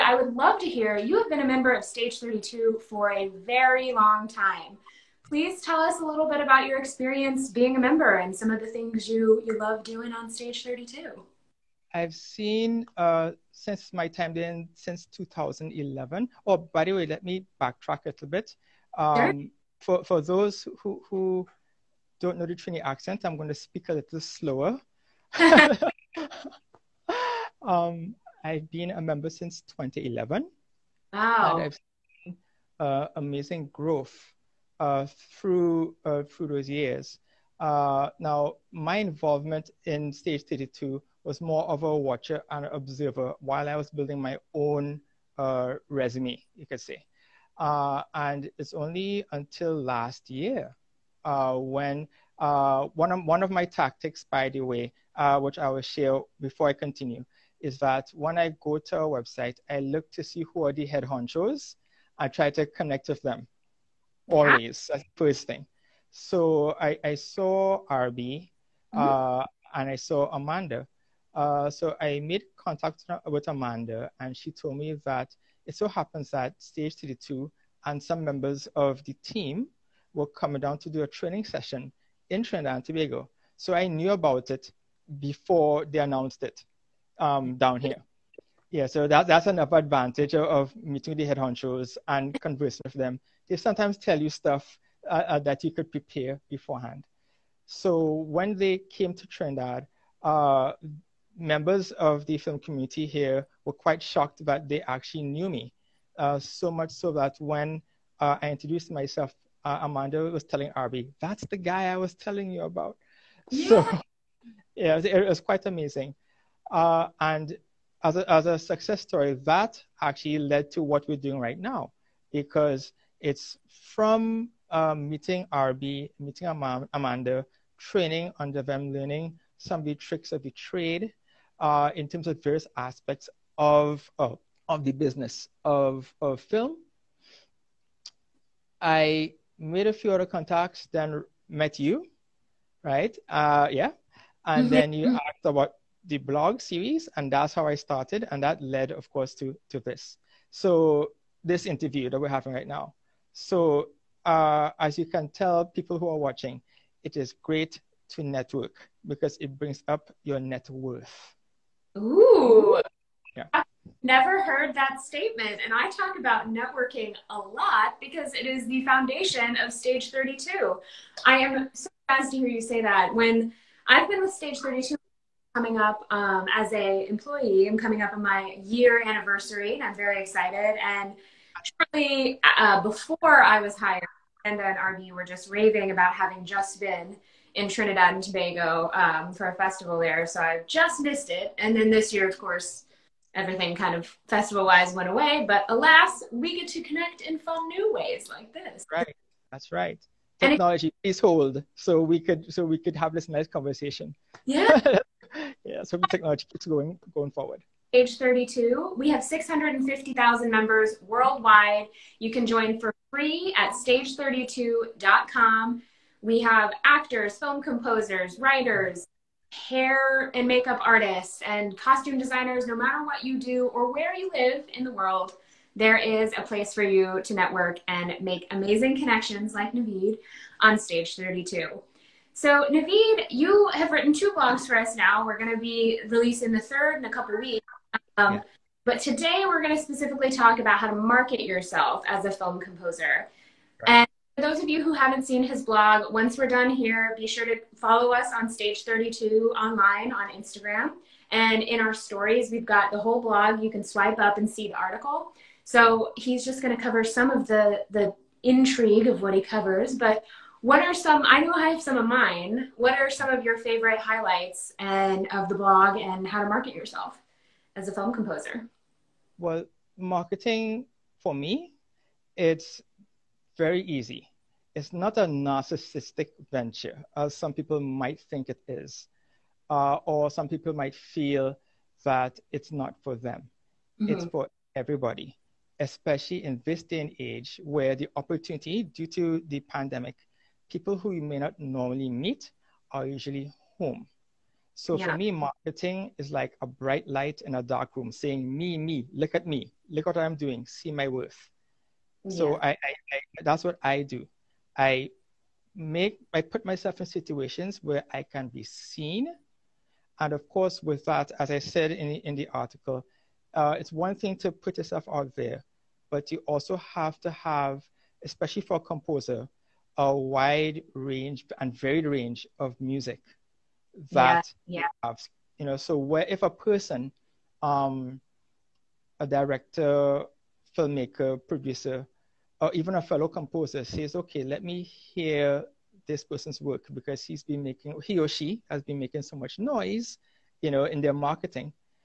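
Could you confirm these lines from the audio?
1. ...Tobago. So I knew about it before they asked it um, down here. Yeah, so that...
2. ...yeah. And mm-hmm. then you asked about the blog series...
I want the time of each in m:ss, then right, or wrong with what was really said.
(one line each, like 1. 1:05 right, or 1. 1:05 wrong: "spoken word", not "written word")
1. 1:22 wrong: "announced", not "asked"
2. 2:23 right.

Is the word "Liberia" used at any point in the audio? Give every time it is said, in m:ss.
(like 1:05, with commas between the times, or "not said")
not said.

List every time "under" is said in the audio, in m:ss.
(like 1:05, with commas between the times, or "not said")
2:08.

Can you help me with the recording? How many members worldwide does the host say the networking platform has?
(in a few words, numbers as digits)
650,000.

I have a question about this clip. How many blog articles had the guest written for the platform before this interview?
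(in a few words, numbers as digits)
2.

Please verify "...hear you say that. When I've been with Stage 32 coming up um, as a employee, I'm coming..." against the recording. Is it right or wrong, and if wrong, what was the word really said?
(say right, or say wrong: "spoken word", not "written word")
right.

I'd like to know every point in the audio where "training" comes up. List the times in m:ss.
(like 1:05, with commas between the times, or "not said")
1:21, 2:07.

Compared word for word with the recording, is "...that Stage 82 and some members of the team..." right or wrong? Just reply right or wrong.
wrong.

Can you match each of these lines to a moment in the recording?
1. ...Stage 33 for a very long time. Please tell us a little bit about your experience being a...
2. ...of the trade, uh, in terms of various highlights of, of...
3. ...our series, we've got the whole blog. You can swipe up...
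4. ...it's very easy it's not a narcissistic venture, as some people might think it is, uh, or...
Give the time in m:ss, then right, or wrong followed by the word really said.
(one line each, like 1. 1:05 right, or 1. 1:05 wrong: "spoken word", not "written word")
1. 0:01 wrong: "32", not "33"
2. 2:10 wrong: "aspects", not "highlights"
3. 4:11 wrong: "stories", not "series"
4. 4:32 right.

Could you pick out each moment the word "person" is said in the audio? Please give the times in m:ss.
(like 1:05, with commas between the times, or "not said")
5:26, 5:36.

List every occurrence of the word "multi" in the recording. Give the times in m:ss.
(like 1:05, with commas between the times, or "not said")
not said.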